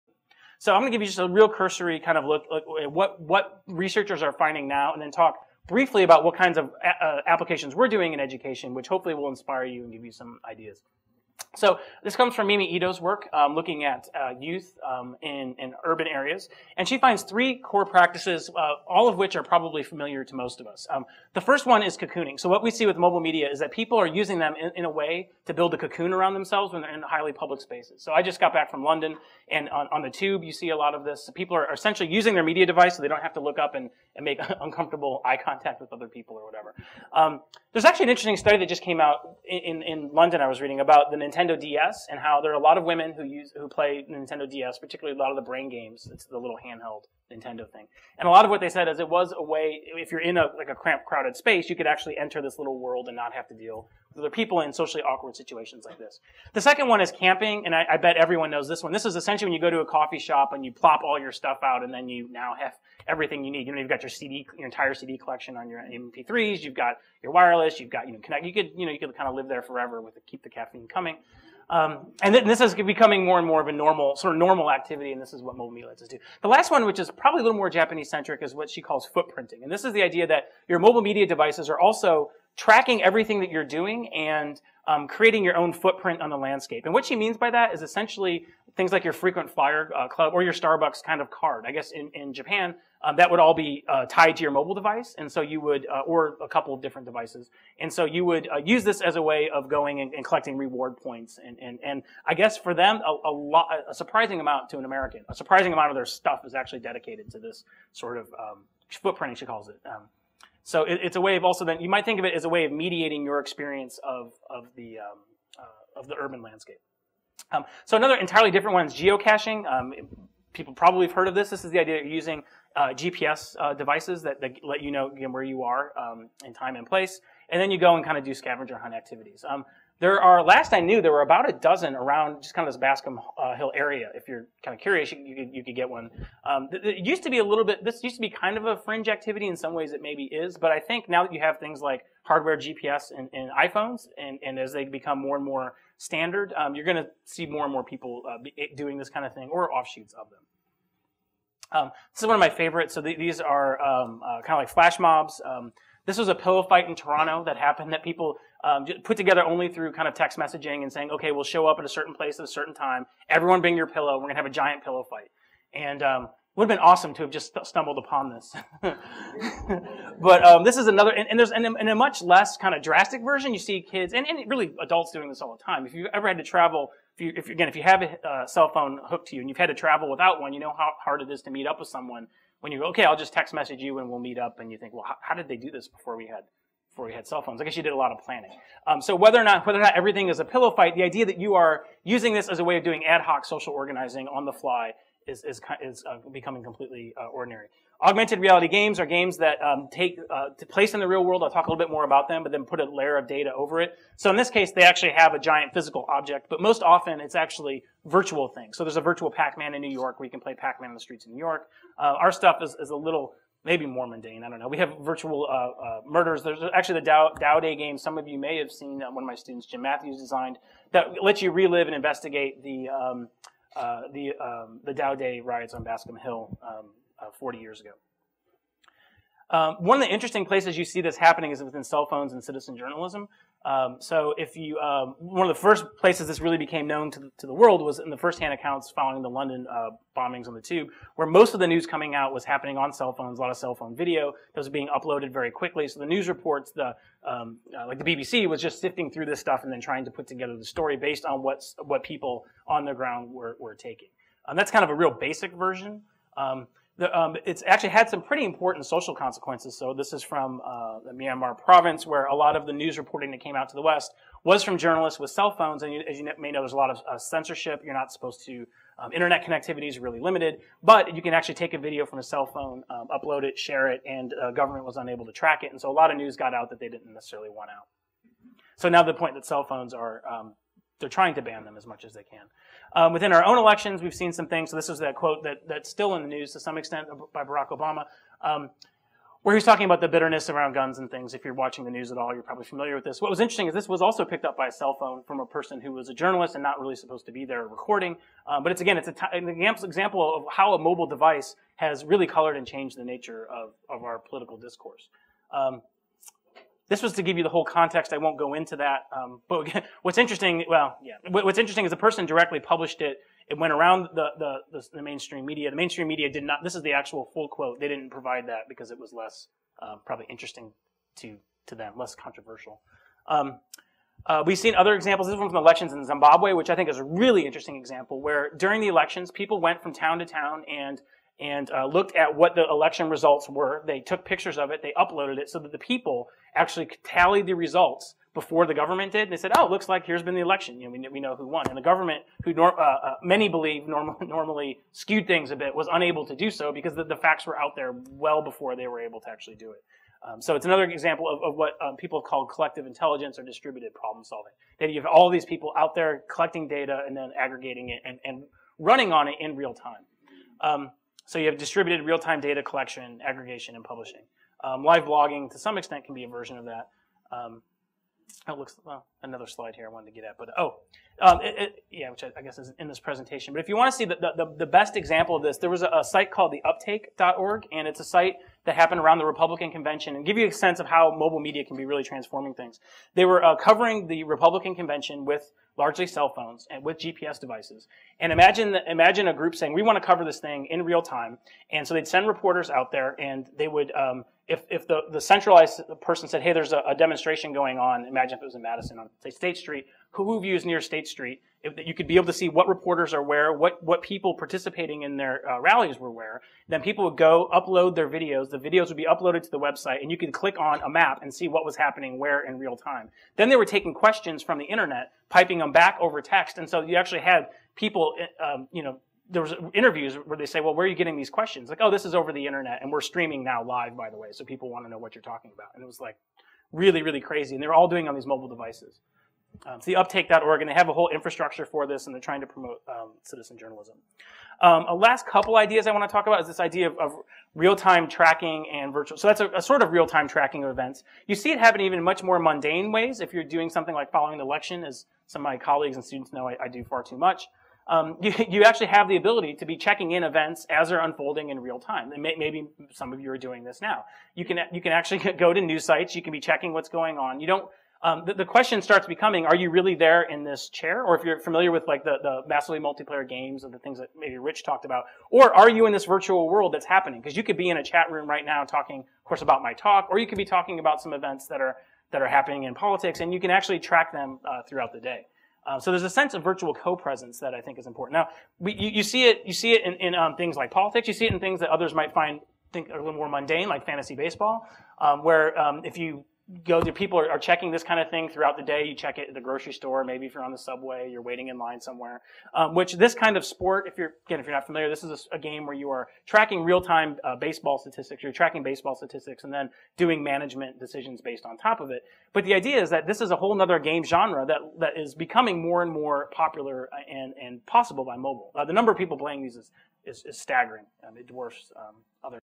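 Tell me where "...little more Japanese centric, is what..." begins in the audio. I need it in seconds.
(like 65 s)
77 s.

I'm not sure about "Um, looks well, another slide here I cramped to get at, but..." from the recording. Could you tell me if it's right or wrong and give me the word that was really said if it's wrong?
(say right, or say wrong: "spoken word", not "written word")
wrong: "wanted", not "cramped".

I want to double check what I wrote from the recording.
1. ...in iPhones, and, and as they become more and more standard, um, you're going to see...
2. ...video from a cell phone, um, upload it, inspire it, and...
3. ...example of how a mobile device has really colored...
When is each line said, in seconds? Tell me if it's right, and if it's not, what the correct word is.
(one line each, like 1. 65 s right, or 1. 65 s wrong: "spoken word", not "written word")
1. 143 s right
2. 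271 s wrong: "share", not "inspire"
3. 299 s right.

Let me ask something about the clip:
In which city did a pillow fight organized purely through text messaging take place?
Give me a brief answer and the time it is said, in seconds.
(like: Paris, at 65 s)
Toronto, at 156 s.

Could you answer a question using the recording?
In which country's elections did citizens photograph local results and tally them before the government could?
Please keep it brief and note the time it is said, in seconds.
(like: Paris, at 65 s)
Zimbabwe, at 326 s.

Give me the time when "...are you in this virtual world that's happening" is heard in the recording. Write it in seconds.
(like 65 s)
465 s.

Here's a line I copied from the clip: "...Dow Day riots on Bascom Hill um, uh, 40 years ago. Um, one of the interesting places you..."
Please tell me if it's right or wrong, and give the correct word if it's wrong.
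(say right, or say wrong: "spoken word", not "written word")
right.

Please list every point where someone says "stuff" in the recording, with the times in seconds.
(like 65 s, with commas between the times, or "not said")
61 s, 106 s, 212 s, 249 s.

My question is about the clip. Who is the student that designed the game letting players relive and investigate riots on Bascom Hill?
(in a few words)
Jim Matthews.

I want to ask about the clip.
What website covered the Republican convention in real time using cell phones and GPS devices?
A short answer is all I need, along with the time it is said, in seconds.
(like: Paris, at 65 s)
theuptake.org, at 376 s.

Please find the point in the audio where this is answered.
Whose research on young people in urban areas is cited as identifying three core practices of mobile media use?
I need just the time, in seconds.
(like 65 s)
12 s.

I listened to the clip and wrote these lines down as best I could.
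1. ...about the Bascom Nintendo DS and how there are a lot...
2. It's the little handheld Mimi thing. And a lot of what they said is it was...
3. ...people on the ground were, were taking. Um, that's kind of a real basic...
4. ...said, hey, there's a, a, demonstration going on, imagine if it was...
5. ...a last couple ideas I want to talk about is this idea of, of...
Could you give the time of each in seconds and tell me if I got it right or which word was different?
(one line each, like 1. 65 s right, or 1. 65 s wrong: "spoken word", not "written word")
1. 40 s wrong: "Nintendo", not "Bascom"
2. 46 s wrong: "Nintendo", not "Mimi"
3. 252 s right
4. 396 s right
5. 434 s right.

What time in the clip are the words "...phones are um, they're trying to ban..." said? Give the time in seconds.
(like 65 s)
279 s.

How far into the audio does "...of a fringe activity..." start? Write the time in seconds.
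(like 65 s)
138 s.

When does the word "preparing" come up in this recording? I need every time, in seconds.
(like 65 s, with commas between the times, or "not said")
not said.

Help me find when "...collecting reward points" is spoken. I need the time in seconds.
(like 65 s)
100 s.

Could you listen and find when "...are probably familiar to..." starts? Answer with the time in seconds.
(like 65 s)
19 s.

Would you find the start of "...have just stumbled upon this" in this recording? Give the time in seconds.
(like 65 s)
167 s.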